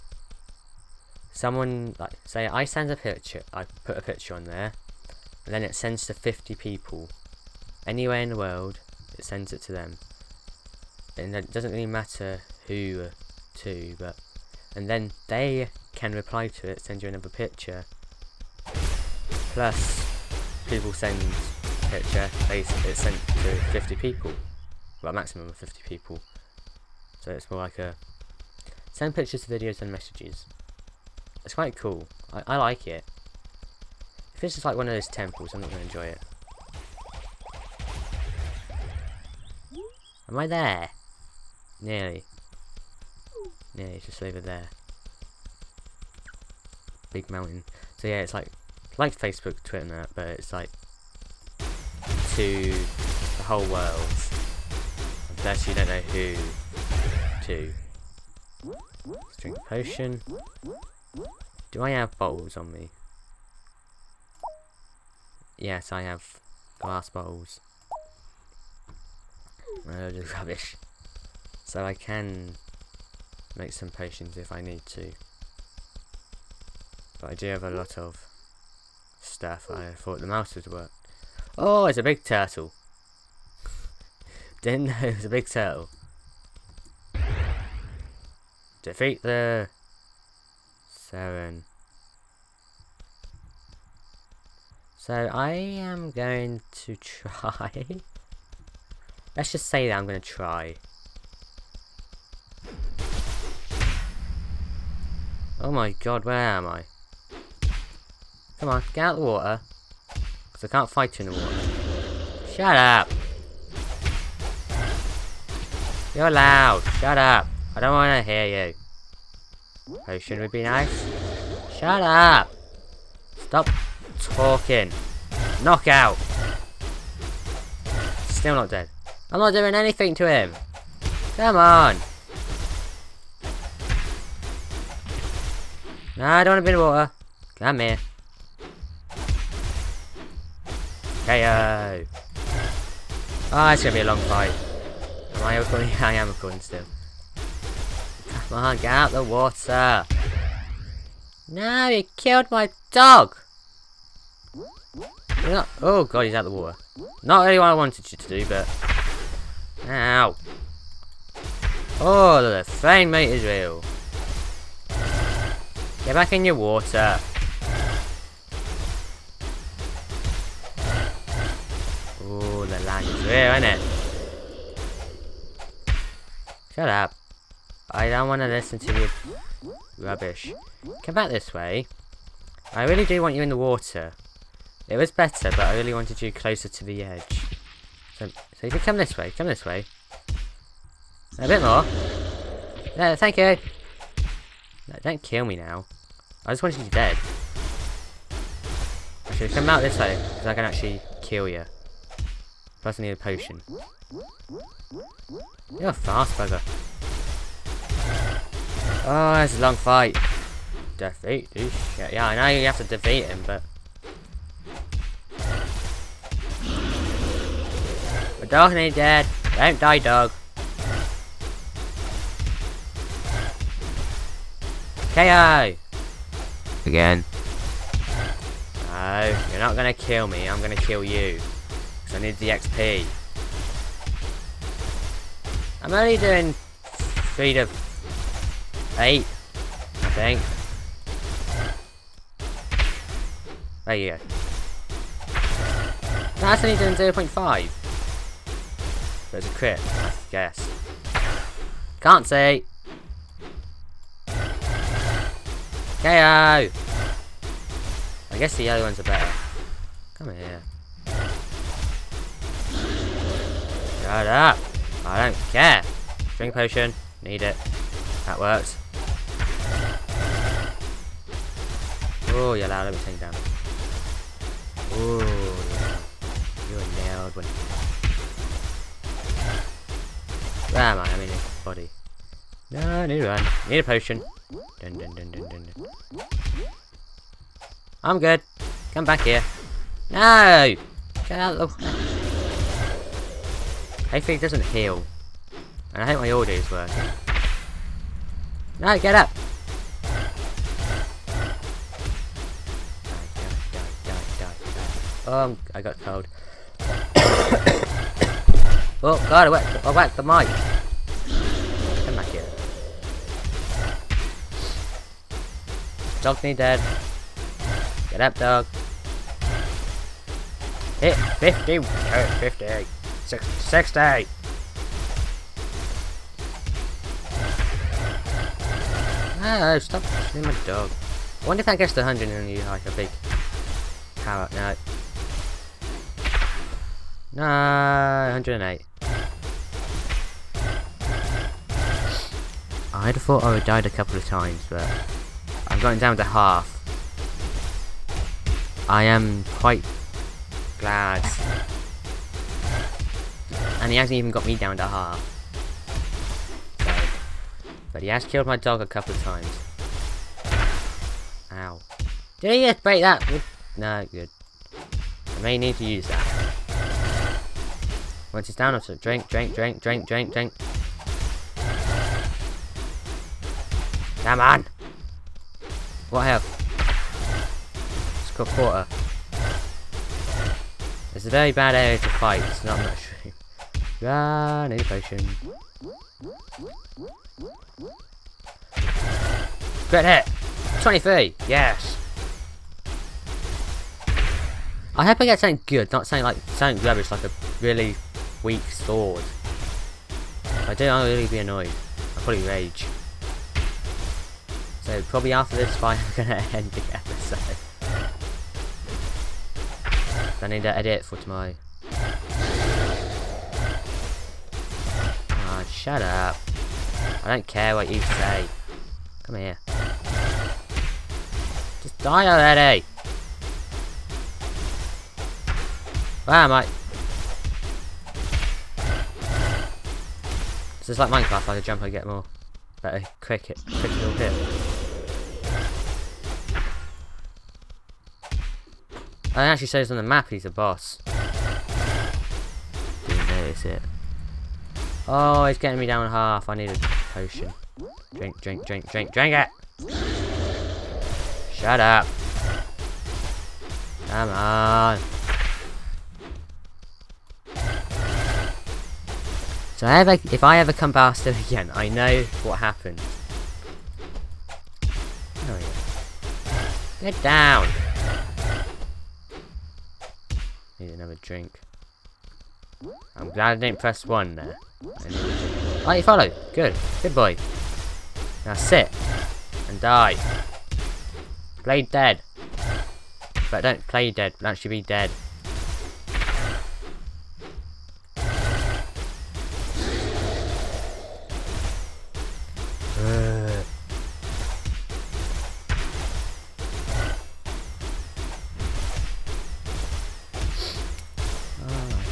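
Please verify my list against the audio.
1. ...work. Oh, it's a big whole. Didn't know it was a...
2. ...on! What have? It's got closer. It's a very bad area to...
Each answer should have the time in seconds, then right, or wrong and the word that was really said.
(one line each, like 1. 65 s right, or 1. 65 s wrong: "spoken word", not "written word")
1. 80 s wrong: "turtle", not "whole"
2. 374 s wrong: "quarter", not "closer".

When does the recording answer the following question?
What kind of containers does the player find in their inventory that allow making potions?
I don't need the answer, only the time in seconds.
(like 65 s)
66 s.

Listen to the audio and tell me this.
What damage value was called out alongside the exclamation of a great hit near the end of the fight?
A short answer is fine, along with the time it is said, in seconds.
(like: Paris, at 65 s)
23, at 390 s.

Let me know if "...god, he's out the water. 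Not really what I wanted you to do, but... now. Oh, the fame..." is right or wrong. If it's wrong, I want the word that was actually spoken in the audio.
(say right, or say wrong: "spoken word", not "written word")
right.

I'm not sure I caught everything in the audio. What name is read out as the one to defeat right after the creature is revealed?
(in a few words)
Seren.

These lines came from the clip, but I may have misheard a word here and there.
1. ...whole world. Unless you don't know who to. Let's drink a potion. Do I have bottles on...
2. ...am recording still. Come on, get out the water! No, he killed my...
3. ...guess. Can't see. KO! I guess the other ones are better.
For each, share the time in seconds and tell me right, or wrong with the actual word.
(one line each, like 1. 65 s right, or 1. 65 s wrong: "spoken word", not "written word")
1. 53 s right
2. 146 s right
3. 250 s right.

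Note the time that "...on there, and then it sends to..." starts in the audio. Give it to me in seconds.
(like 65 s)
4 s.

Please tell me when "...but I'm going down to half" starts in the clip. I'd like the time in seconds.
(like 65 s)
344 s.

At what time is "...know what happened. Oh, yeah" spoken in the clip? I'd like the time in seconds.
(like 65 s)
461 s.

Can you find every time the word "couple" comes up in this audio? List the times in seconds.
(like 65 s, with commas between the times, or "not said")
343 s, 358 s.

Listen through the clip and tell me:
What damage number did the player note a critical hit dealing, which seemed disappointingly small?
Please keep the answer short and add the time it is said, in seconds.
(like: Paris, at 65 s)
0.5, at 246 s.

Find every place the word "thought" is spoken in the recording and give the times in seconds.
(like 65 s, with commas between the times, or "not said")
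79 s, 343 s.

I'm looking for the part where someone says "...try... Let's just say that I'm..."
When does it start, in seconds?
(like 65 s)
96 s.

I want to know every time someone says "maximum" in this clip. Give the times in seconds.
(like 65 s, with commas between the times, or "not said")
25 s.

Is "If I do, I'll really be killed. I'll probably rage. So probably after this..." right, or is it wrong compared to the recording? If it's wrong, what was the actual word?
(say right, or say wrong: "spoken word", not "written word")
wrong: "annoyed", not "killed".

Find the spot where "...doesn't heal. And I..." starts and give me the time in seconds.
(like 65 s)
294 s.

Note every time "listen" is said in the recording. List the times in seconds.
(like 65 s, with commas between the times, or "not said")
178 s.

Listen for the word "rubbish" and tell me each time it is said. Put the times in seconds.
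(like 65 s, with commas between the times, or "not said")
70 s, 179 s, 396 s.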